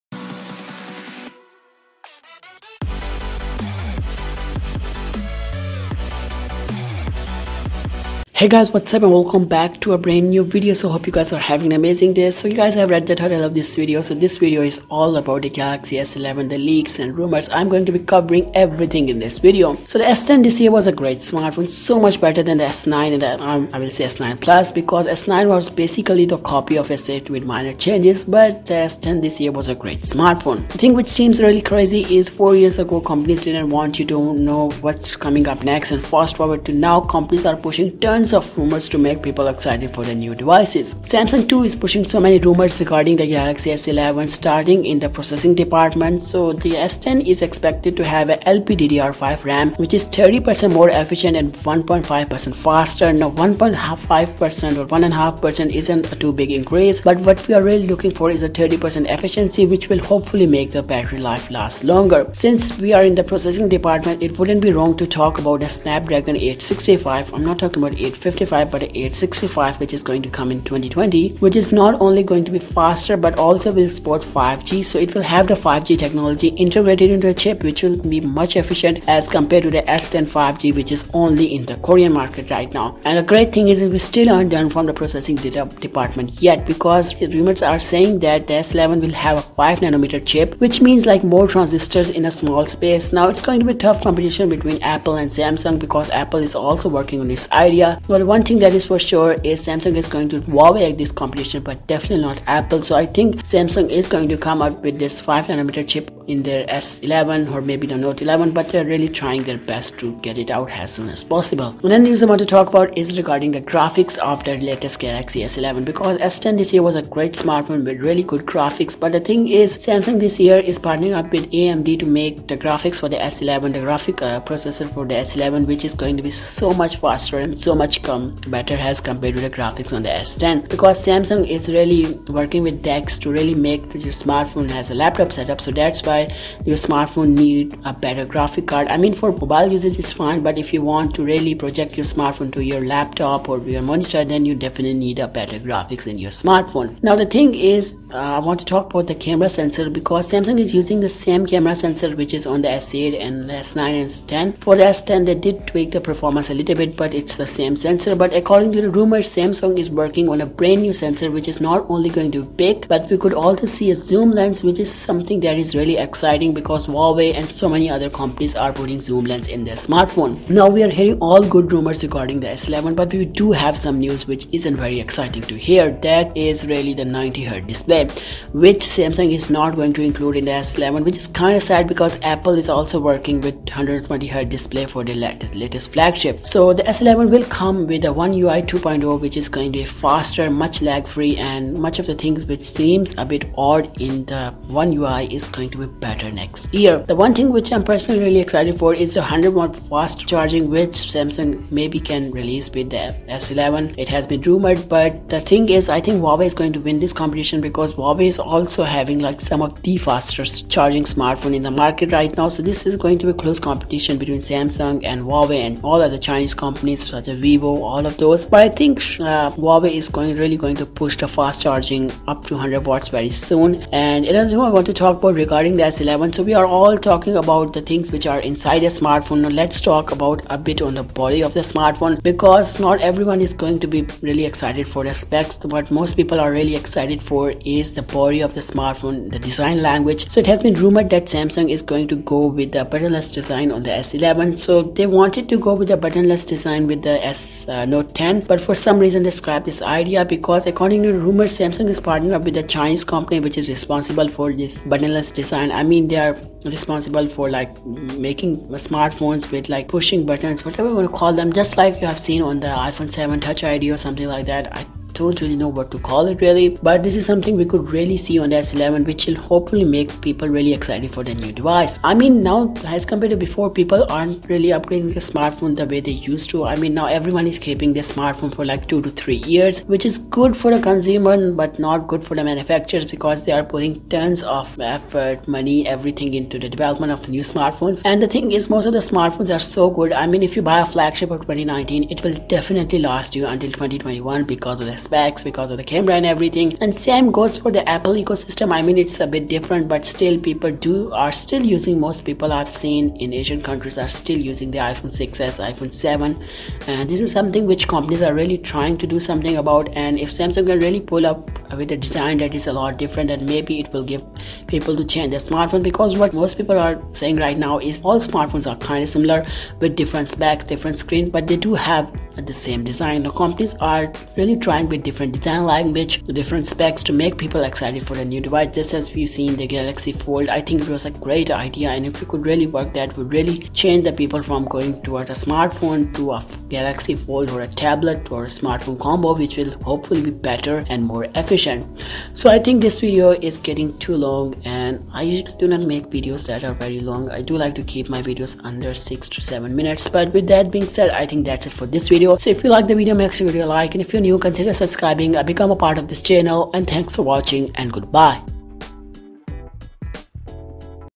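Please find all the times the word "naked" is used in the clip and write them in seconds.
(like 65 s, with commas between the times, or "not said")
not said.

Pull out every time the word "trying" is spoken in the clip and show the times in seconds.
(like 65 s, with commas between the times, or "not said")
109 s, 308 s, 324 s.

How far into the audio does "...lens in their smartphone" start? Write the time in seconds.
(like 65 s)
169 s.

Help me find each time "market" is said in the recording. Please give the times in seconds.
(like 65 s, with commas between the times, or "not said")
82 s, 211 s.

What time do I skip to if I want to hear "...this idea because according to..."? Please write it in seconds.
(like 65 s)
249 s.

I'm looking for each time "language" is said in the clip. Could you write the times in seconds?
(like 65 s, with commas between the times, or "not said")
239 s, 325 s.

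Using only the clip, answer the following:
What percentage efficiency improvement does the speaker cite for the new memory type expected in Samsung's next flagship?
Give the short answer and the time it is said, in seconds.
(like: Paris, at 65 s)
30%, at 50 s.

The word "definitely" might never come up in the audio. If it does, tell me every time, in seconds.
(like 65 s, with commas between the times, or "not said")
101 s, 144 s, 292 s.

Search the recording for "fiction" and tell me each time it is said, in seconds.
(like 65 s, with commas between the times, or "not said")
not said.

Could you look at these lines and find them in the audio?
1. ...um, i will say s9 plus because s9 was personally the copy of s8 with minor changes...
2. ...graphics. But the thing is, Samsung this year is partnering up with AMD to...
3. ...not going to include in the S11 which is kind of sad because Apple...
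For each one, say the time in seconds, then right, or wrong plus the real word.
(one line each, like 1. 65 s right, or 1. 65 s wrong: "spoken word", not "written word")
1. 23 s wrong: "basically", not "personally"
2. 118 s right
3. 179 s right.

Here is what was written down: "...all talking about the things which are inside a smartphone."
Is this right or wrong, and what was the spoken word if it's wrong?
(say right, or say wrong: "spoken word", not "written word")
right.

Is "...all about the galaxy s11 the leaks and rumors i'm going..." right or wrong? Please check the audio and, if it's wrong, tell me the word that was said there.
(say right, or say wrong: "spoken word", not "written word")
right.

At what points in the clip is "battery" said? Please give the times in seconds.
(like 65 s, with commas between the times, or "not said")
60 s.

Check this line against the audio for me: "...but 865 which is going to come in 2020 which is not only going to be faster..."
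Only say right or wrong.
right.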